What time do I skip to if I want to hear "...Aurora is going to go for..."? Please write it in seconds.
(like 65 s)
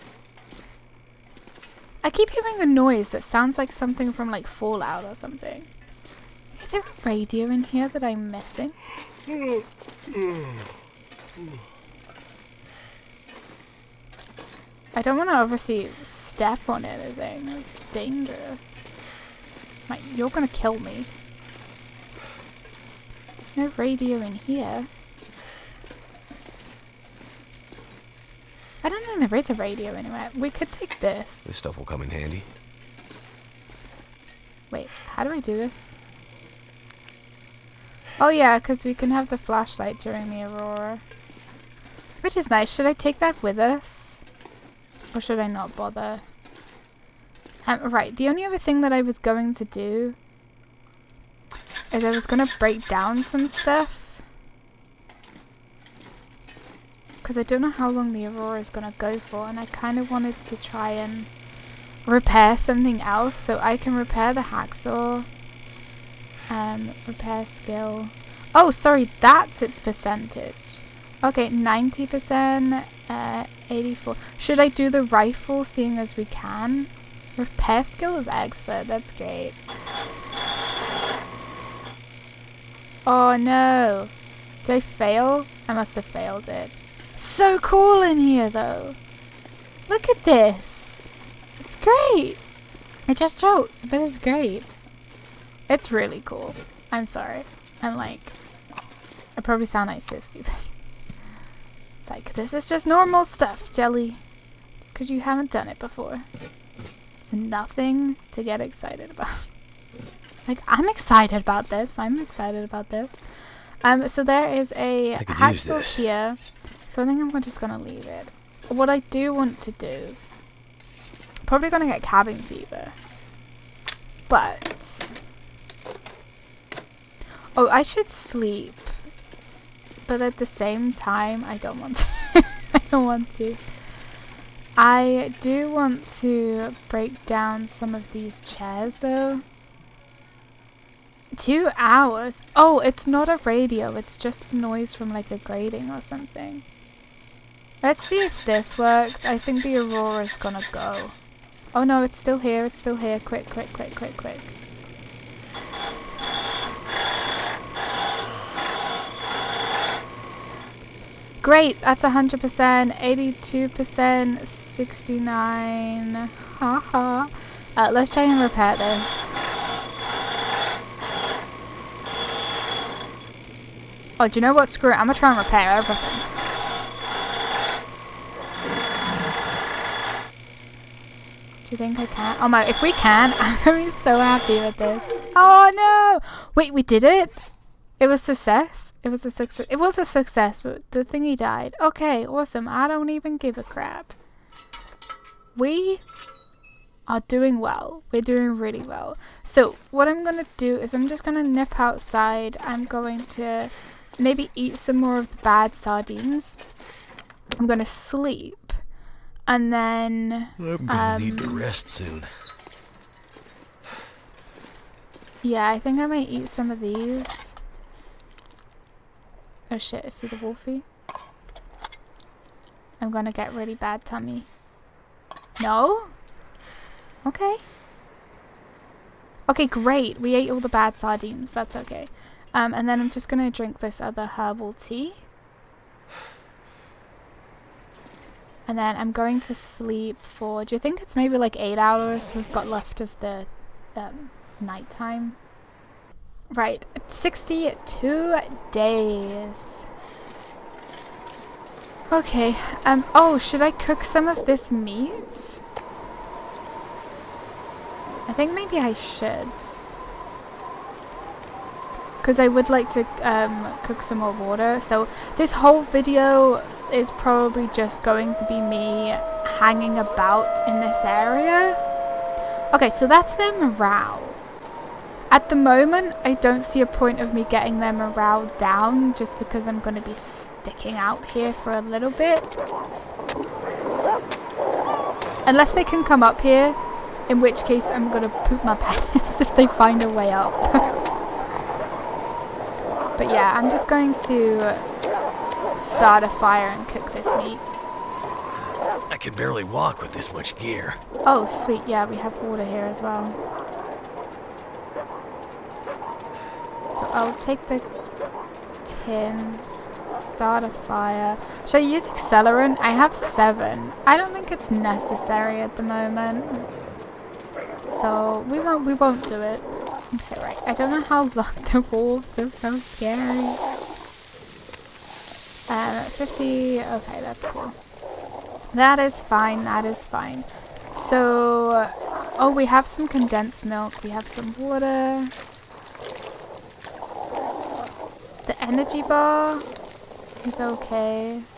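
58 s.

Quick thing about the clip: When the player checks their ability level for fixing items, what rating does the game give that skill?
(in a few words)
expert.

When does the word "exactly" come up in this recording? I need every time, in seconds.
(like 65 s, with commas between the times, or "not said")
not said.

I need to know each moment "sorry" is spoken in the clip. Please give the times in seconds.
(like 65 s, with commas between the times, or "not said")
68 s, 97 s.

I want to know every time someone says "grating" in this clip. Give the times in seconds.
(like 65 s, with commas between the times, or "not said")
145 s.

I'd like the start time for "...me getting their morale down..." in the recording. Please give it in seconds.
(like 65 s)
277 s.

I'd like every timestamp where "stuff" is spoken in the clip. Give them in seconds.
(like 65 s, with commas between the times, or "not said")
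31 s, 53 s, 103 s.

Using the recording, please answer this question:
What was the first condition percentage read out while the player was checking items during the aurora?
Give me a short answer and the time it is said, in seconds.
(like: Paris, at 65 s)
100%, at 162 s.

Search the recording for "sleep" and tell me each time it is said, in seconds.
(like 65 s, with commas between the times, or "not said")
128 s, 207 s, 239 s.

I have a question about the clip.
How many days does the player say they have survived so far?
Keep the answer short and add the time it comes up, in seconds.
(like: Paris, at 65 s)
62 days, at 247 s.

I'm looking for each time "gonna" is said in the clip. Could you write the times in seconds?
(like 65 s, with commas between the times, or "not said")
20 s, 150 s, 175 s, 210 s, 223 s, 233 s.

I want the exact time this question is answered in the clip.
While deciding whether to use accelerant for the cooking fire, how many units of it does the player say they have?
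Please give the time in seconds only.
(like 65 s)
313 s.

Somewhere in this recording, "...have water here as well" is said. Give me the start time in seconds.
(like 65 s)
302 s.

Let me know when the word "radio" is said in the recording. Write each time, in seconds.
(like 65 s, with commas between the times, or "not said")
7 s, 23 s, 29 s, 143 s.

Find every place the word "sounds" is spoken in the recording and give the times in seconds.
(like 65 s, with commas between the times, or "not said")
3 s, 99 s.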